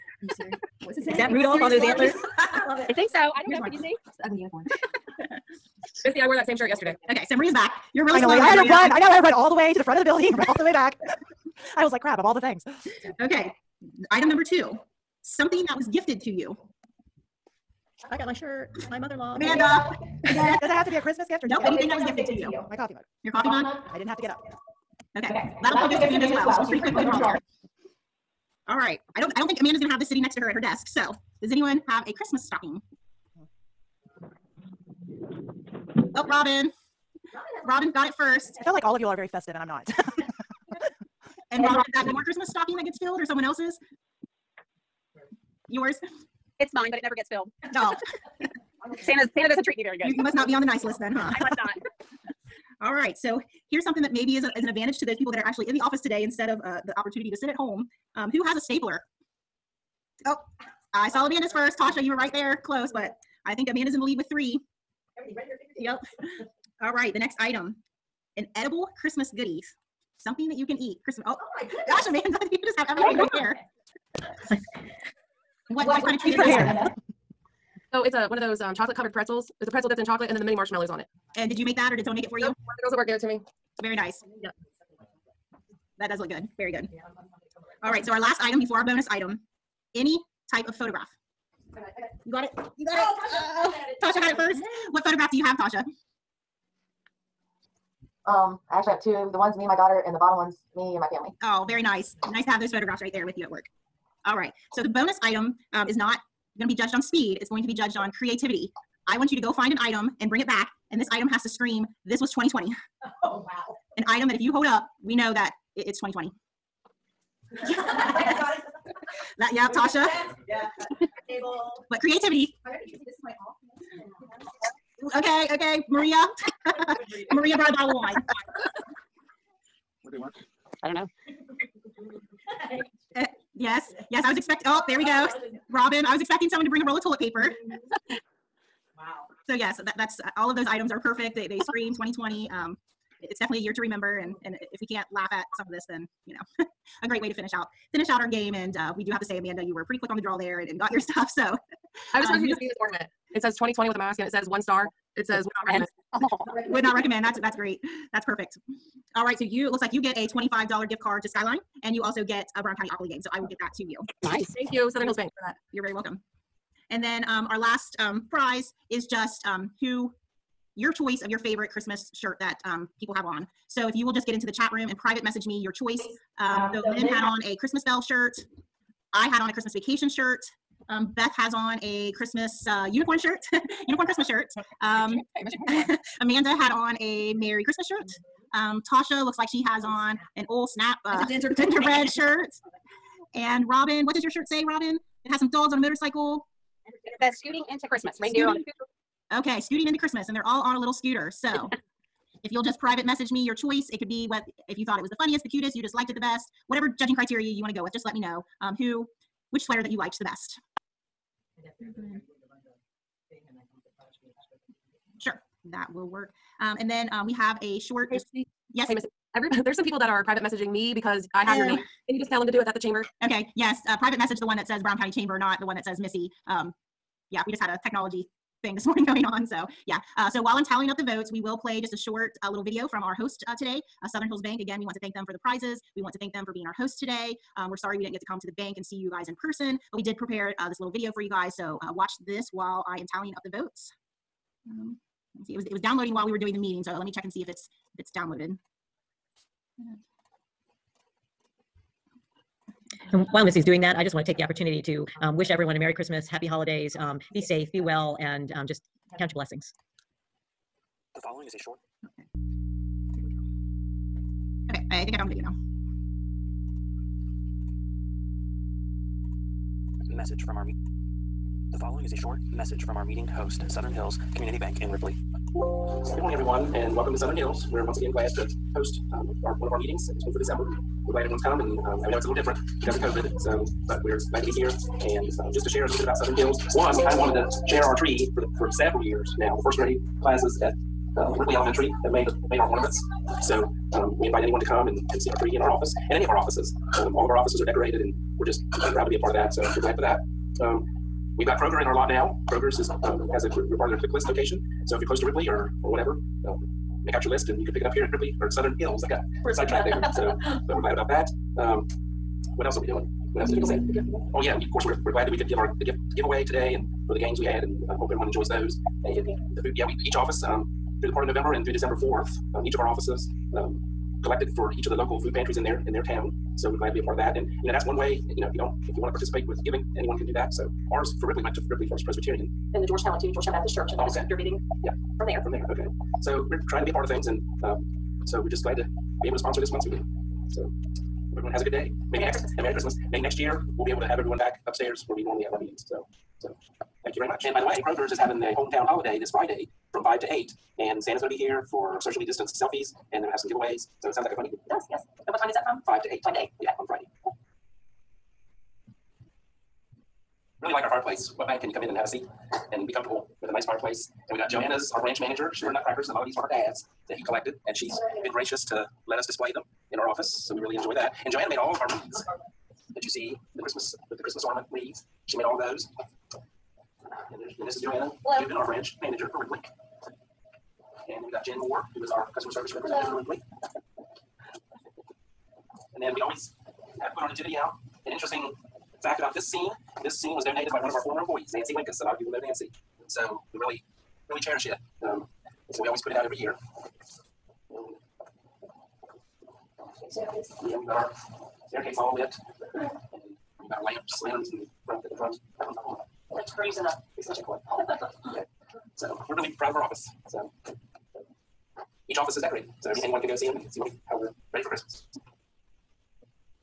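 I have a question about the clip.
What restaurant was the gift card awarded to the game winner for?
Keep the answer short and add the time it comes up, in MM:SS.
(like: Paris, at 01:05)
Skyline, at 02:41.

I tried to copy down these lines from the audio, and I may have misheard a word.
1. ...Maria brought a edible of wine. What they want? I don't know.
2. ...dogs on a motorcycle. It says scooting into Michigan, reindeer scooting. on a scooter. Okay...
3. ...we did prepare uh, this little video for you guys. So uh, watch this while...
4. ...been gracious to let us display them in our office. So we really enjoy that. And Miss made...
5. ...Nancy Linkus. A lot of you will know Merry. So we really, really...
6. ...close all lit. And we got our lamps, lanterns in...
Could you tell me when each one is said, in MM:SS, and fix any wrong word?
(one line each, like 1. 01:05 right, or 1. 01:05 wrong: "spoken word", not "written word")
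1. 02:07 wrong: "bottle", not "edible"
2. 03:15 wrong: "Christmas", not "Michigan"
3. 03:59 right
4. 06:08 wrong: "Joanna", not "Miss"
5. 06:31 wrong: "Nancy", not "Merry"
6. 06:41 wrong: "staircase", not "close".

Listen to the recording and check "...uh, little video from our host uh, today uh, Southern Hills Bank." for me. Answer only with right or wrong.
right.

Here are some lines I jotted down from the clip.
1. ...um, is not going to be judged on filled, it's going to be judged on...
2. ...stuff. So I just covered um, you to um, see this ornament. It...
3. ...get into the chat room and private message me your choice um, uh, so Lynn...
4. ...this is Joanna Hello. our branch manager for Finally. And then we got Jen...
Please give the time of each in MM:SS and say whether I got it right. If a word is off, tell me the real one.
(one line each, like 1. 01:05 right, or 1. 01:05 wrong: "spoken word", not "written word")
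1. 01:45 wrong: "speed", not "filled"
2. 02:30 wrong: "wanted", not "covered"
3. 02:54 right
4. 06:17 wrong: "Ripley", not "Finally".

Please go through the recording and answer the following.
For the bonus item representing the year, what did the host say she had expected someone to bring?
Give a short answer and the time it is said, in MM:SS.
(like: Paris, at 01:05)
A roll of toilet paper, at 02:16.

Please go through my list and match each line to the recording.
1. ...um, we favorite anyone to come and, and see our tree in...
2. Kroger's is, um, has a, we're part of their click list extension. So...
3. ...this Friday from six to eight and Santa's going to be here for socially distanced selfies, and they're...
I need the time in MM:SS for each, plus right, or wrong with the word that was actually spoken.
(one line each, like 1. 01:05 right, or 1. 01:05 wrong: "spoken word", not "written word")
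1. 04:53 wrong: "invite", not "favorite"
2. 05:02 wrong: "location", not "extension"
3. 05:49 wrong: "five", not "six".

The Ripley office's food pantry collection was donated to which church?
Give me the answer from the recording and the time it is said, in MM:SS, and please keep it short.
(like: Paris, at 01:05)
Ripley First Presbyterian, at 05:31.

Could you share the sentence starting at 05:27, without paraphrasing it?
And you know, that's one way.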